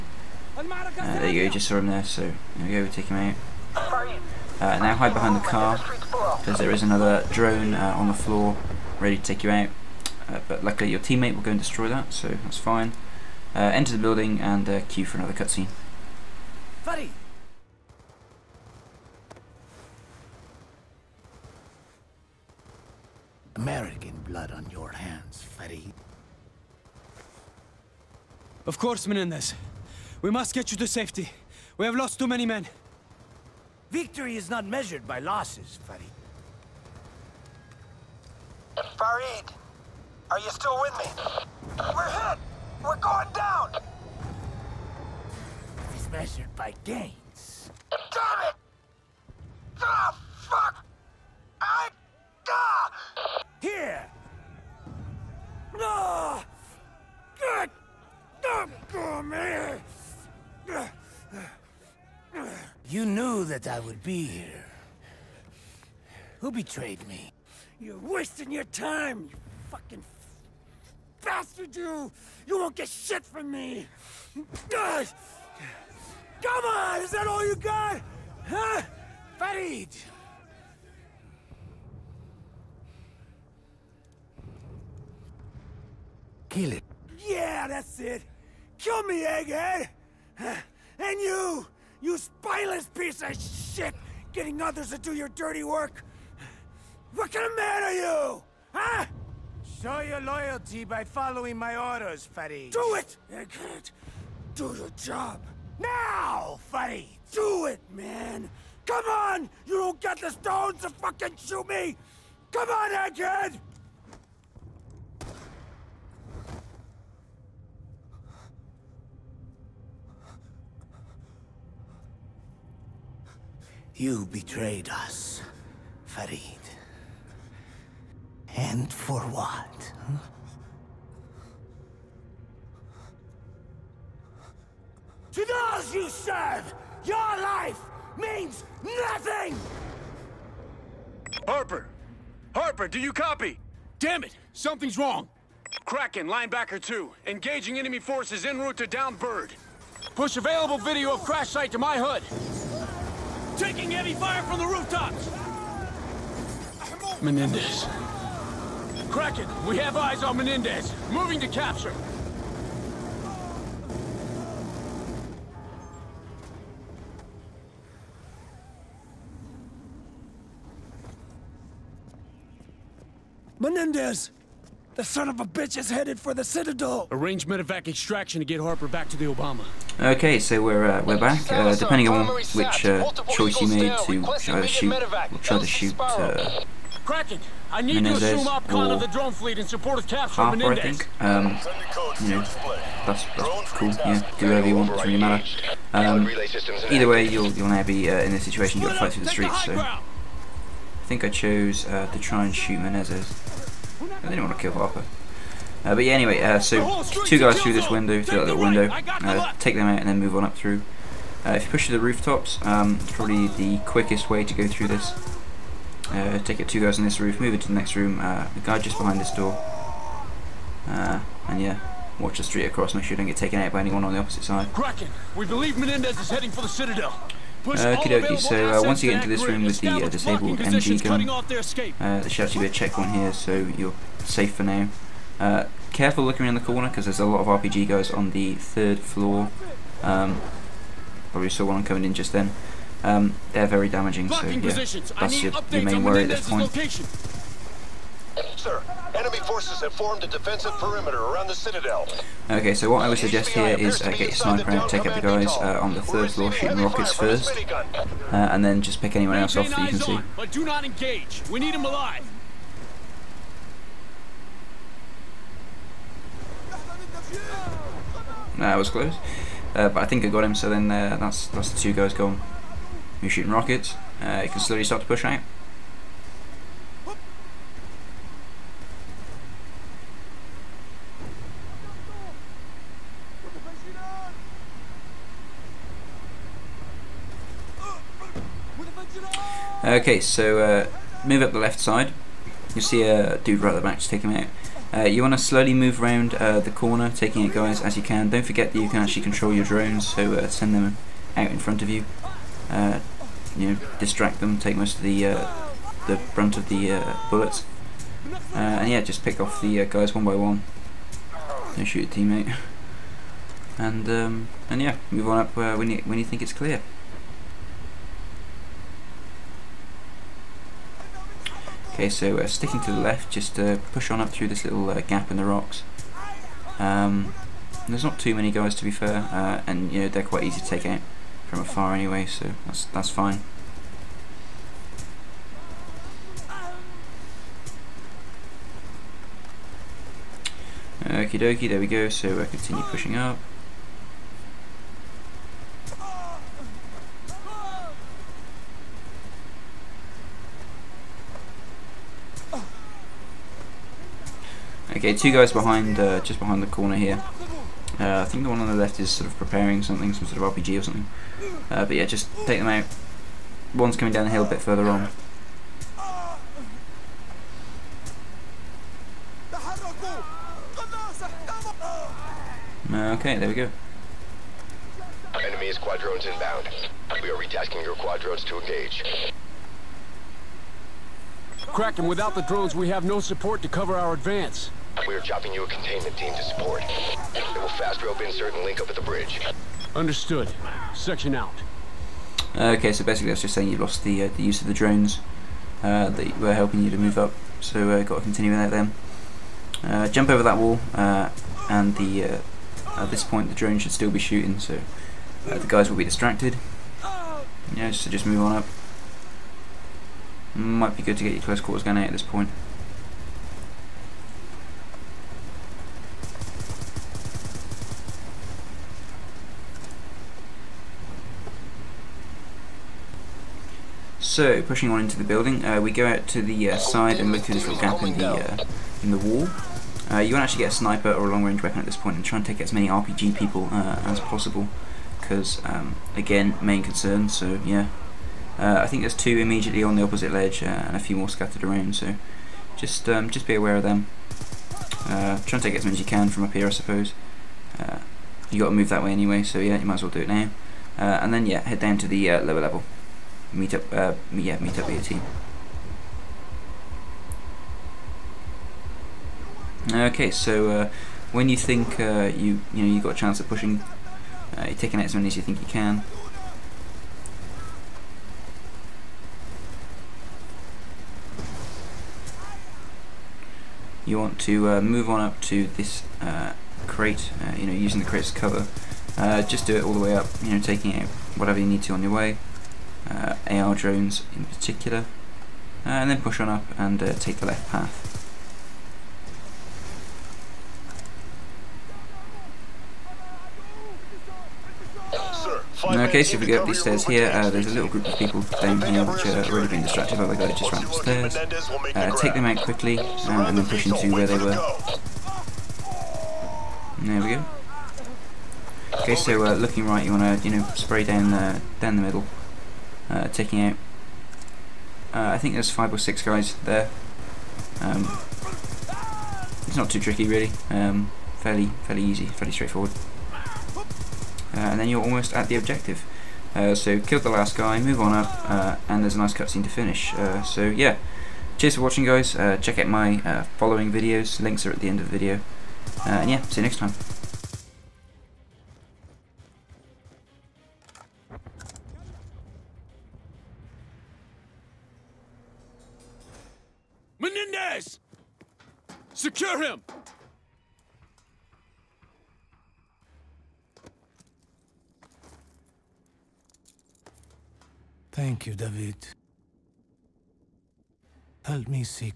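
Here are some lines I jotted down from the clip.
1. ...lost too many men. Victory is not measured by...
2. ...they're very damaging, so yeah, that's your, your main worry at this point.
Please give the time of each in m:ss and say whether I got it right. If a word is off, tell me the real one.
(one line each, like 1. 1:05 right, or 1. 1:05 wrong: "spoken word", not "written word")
1. 0:31 right
2. 4:03 right.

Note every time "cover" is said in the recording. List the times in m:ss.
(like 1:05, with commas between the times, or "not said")
6:23, 7:58.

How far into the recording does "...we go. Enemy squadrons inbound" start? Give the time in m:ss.
6:13.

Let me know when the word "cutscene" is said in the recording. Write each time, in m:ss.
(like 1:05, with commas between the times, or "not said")
0:15, 8:49.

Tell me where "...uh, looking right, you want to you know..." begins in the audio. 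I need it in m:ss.
8:29.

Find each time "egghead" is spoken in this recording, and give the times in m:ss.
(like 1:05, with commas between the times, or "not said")
1:29, 1:52.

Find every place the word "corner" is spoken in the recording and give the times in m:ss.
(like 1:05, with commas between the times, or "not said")
3:56, 4:56, 5:56.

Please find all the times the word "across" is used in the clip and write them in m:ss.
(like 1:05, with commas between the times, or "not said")
3:42.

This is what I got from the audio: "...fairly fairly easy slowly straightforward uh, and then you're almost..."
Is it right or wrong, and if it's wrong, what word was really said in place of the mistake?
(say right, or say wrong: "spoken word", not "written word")
wrong: "fairly", not "slowly".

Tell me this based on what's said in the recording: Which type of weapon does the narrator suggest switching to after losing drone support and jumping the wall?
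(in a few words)
Close quarters gun.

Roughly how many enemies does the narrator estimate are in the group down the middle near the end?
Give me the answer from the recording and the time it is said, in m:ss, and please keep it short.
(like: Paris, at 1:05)
5 or 6, at 8:35.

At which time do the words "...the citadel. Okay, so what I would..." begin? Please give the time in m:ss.
4:11.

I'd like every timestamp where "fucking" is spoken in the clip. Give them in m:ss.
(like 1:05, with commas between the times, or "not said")
1:09, 1:50.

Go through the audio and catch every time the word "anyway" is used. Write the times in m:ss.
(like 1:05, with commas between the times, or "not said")
3:26, 5:31, 7:29.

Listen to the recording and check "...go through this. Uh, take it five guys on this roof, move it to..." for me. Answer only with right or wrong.
wrong.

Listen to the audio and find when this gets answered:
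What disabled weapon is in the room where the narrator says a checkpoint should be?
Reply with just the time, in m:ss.
3:50.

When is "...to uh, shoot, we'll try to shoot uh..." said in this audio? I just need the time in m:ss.
3:04.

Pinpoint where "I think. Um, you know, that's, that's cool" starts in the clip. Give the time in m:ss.
3:10.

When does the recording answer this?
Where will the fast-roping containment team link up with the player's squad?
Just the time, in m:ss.
6:28.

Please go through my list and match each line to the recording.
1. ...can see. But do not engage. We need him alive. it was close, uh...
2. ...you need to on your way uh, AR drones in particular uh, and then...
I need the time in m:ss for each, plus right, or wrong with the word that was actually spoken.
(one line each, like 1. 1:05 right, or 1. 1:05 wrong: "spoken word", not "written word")
1. 4:19 right
2. 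8:01 right.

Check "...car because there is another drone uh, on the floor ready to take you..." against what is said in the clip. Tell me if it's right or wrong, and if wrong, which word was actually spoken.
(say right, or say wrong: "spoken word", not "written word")
right.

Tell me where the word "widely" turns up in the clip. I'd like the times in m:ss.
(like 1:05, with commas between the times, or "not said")
not said.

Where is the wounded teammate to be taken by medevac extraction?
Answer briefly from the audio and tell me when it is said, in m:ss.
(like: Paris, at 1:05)
The Obama, at 2:58.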